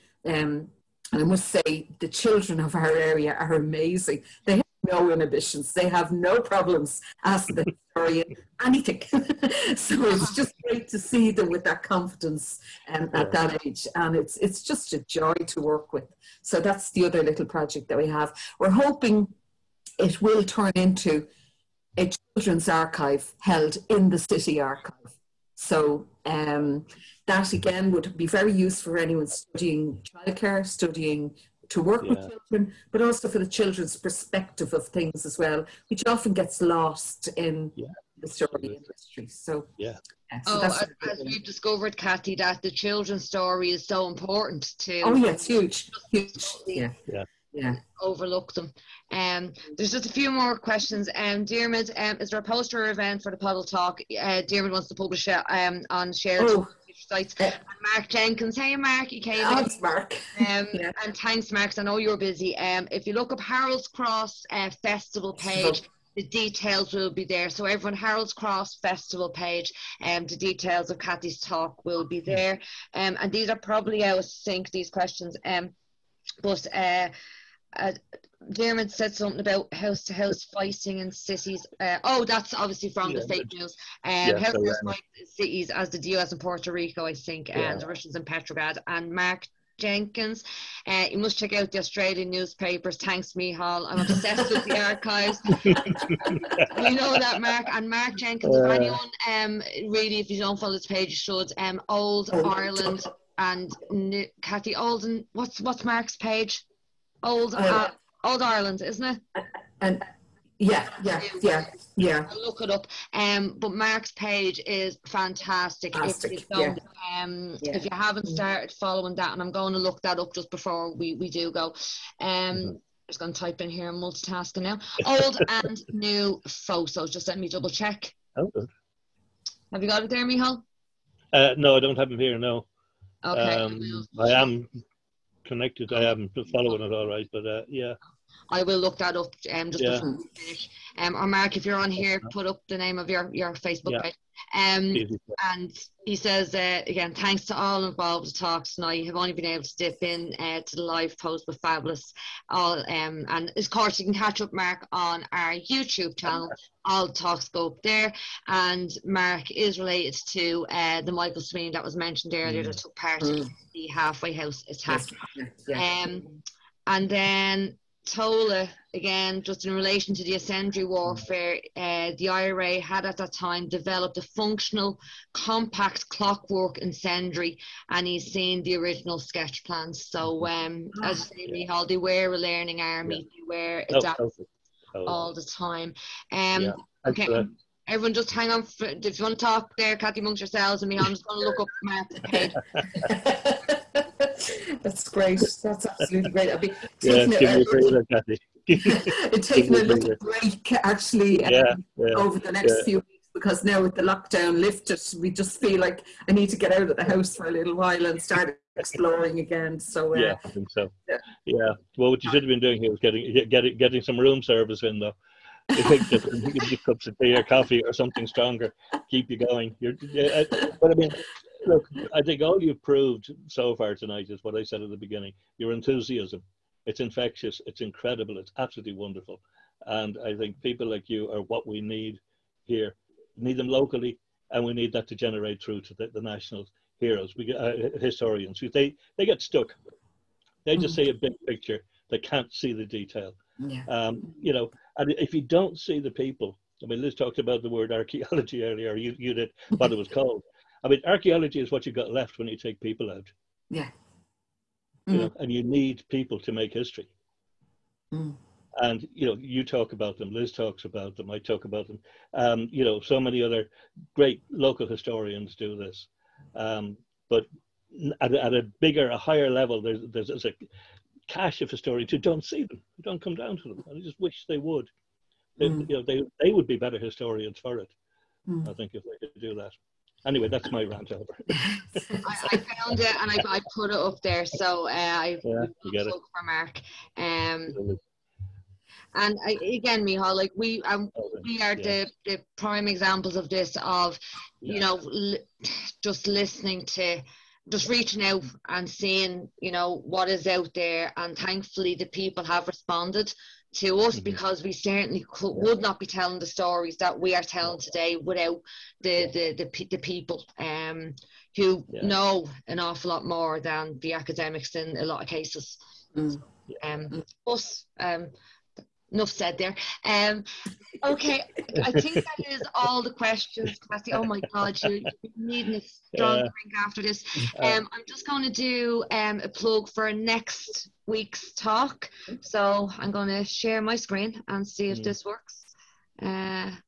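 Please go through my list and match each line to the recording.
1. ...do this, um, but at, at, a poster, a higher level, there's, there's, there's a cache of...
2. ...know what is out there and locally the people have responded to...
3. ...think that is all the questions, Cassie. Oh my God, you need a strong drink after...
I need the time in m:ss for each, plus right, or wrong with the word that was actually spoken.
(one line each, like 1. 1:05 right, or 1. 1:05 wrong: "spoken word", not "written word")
1. 4:25 wrong: "bigger", not "poster"
2. 4:59 wrong: "thankfully", not "locally"
3. 5:21 right.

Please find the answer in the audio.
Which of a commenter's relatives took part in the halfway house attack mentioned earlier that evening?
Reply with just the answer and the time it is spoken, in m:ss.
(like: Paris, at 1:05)
Michael Sweeney, at 2:41.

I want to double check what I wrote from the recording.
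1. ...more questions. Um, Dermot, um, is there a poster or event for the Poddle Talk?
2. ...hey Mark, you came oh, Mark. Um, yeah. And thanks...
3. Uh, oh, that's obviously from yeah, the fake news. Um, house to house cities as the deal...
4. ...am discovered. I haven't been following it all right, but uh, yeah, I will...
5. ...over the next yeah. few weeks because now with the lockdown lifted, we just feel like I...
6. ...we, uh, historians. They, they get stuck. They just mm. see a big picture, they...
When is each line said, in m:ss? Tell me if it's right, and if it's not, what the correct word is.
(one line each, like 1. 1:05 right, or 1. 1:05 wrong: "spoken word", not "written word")
1. 0:50 right
2. 0:58 right
3. 1:21 right
4. 2:14 wrong: "connected", not "discovered"
5. 3:22 right
6. 3:57 right.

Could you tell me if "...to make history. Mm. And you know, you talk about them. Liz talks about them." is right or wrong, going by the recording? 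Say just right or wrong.
right.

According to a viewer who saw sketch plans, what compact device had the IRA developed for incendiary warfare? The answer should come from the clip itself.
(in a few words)
clockwork incendiary.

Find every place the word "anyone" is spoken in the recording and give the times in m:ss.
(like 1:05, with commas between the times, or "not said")
0:28, 1:38.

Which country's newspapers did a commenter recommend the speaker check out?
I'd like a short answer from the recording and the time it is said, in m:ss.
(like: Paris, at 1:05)
Australian, at 1:31.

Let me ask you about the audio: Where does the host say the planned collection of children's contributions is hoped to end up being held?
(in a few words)
city archive.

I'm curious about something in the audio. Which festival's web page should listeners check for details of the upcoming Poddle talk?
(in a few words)
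Harold's Cross Festival.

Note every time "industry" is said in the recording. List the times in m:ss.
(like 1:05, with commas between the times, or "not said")
0:38.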